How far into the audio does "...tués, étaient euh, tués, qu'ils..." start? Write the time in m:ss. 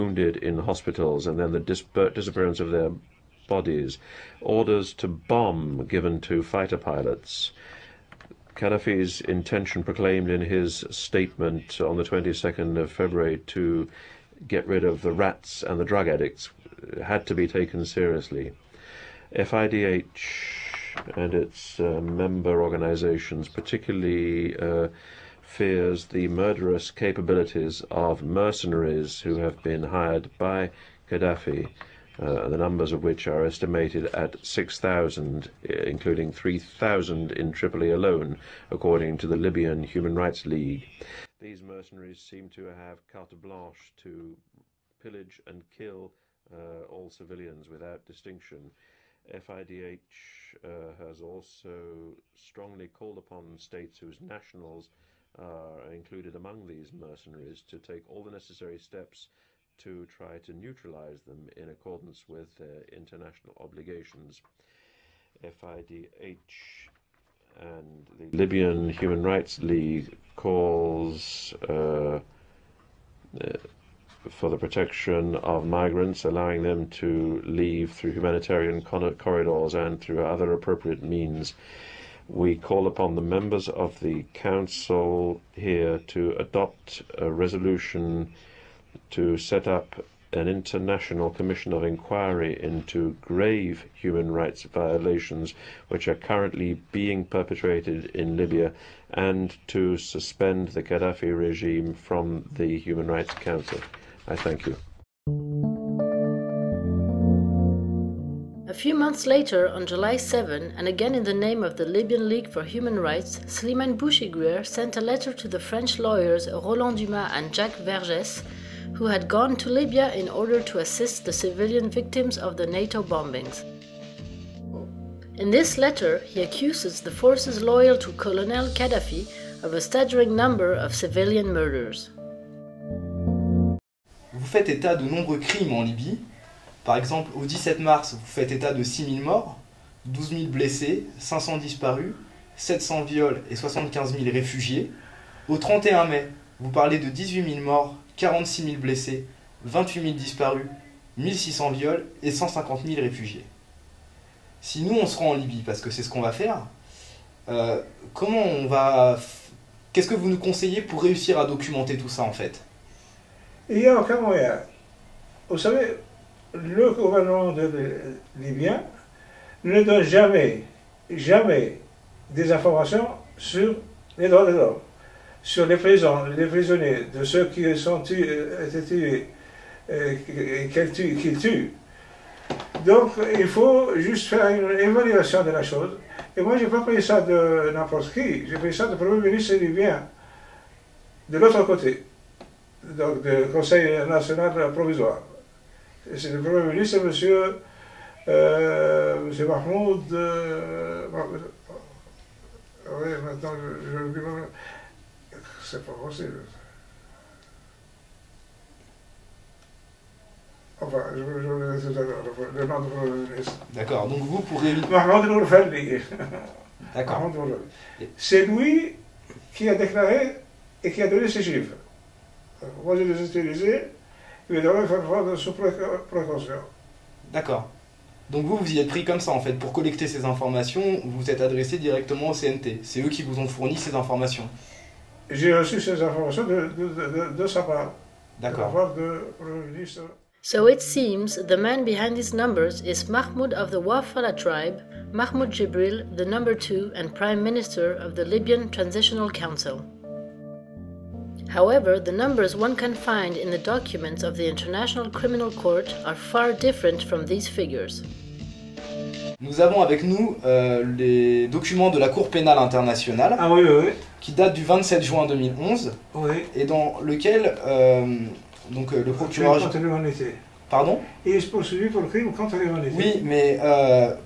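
2:58.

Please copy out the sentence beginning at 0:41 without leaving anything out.
These mercenaries seem to have carte blanche to pillage and kill uh, all civilians without distinction.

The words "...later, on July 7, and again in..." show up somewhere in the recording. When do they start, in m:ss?
1:49.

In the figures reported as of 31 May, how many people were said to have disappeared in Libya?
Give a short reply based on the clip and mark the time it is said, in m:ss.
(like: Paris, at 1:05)
28,000, at 2:29.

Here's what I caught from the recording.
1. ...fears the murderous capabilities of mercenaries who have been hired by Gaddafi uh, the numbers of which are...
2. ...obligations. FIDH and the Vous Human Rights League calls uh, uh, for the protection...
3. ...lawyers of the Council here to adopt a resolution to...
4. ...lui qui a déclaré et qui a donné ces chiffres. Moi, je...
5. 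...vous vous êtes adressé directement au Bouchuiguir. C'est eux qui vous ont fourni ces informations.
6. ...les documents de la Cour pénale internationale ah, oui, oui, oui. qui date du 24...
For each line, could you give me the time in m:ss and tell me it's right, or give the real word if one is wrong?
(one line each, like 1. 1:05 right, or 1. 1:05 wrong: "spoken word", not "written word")
1. 0:25 right
2. 1:03 wrong: "Libyan", not "Vous"
3. 1:23 wrong: "members", not "lawyers"
4. 3:38 right
5. 3:51 wrong: "CNT", not "Bouchuiguir"
6. 4:20 wrong: "27", not "24".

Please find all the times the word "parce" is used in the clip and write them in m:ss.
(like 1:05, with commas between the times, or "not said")
2:35.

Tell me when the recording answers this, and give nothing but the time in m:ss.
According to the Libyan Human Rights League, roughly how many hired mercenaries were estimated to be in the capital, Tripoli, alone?
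0:36.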